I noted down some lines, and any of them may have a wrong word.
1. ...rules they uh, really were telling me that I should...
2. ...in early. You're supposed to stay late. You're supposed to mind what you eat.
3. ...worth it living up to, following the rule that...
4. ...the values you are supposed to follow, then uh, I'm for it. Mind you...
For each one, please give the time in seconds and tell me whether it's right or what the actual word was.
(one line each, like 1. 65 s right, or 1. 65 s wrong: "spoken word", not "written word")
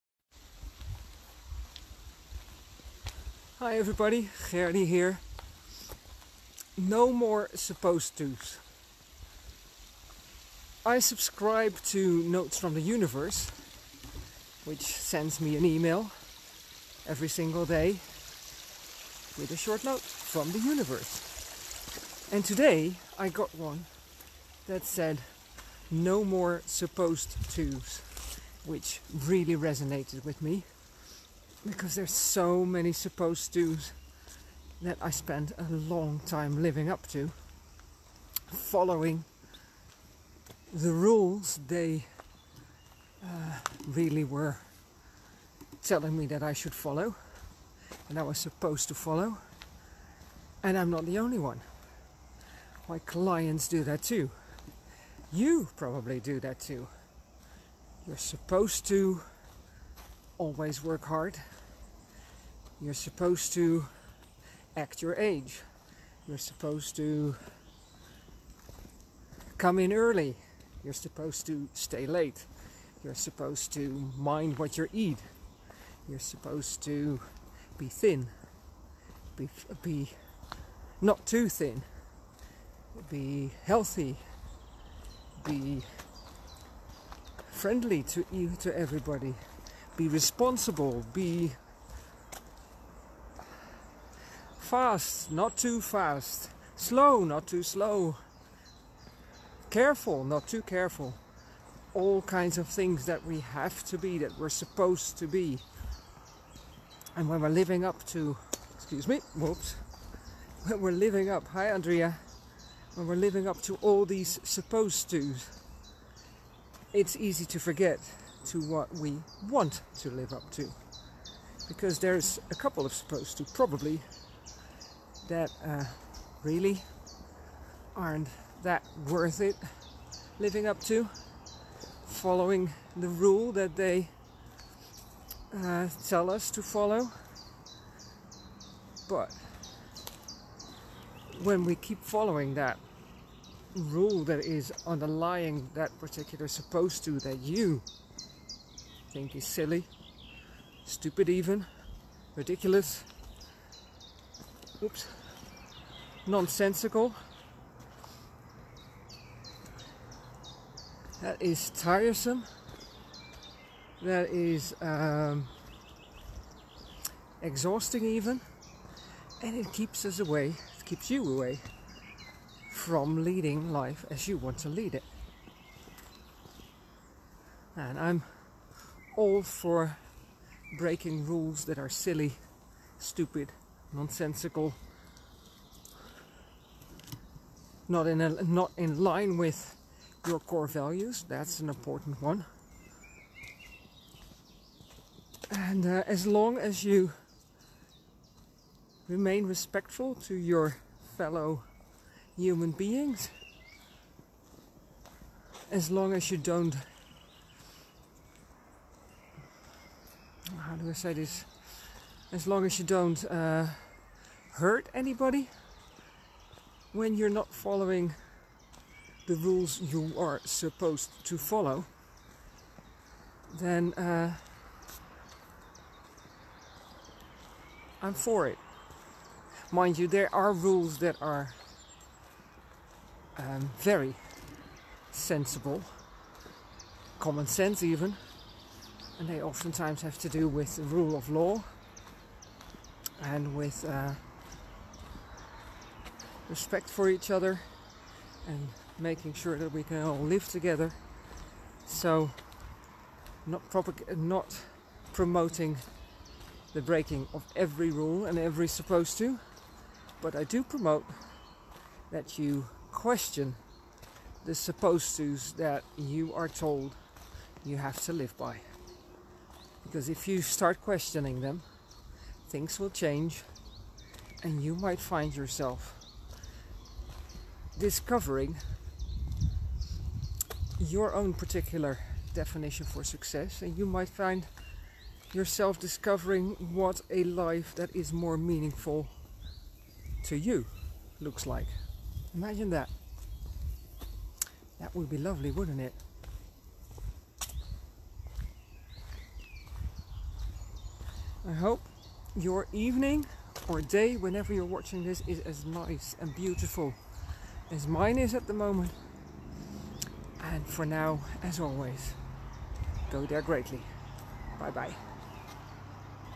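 1. 40 s right
2. 69 s right
3. 129 s right
4. 219 s wrong: "rules", not "values".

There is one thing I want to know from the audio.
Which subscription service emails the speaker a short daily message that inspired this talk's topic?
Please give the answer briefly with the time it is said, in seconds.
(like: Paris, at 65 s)
Notes from the Universe, at 12 s.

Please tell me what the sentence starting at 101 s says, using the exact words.
All kinds of things that we have to be, that we're supposed to be.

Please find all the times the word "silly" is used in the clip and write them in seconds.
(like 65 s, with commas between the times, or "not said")
149 s, 181 s.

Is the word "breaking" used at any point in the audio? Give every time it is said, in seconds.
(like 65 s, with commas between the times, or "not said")
180 s, 256 s.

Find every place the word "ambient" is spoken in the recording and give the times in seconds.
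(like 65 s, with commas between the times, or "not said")
not said.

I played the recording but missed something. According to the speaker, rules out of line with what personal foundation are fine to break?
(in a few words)
core values.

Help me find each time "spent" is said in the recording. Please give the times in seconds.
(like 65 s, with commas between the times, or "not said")
35 s.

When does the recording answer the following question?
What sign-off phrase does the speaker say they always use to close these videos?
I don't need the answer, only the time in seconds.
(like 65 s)
313 s.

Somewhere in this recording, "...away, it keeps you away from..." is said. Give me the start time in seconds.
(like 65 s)
170 s.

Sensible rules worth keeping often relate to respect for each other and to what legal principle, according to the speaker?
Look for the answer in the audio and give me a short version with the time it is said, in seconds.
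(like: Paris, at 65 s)
rule of law, at 240 s.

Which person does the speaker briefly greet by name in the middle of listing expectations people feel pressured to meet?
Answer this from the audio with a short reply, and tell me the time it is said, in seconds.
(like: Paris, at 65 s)
Andrea, at 111 s.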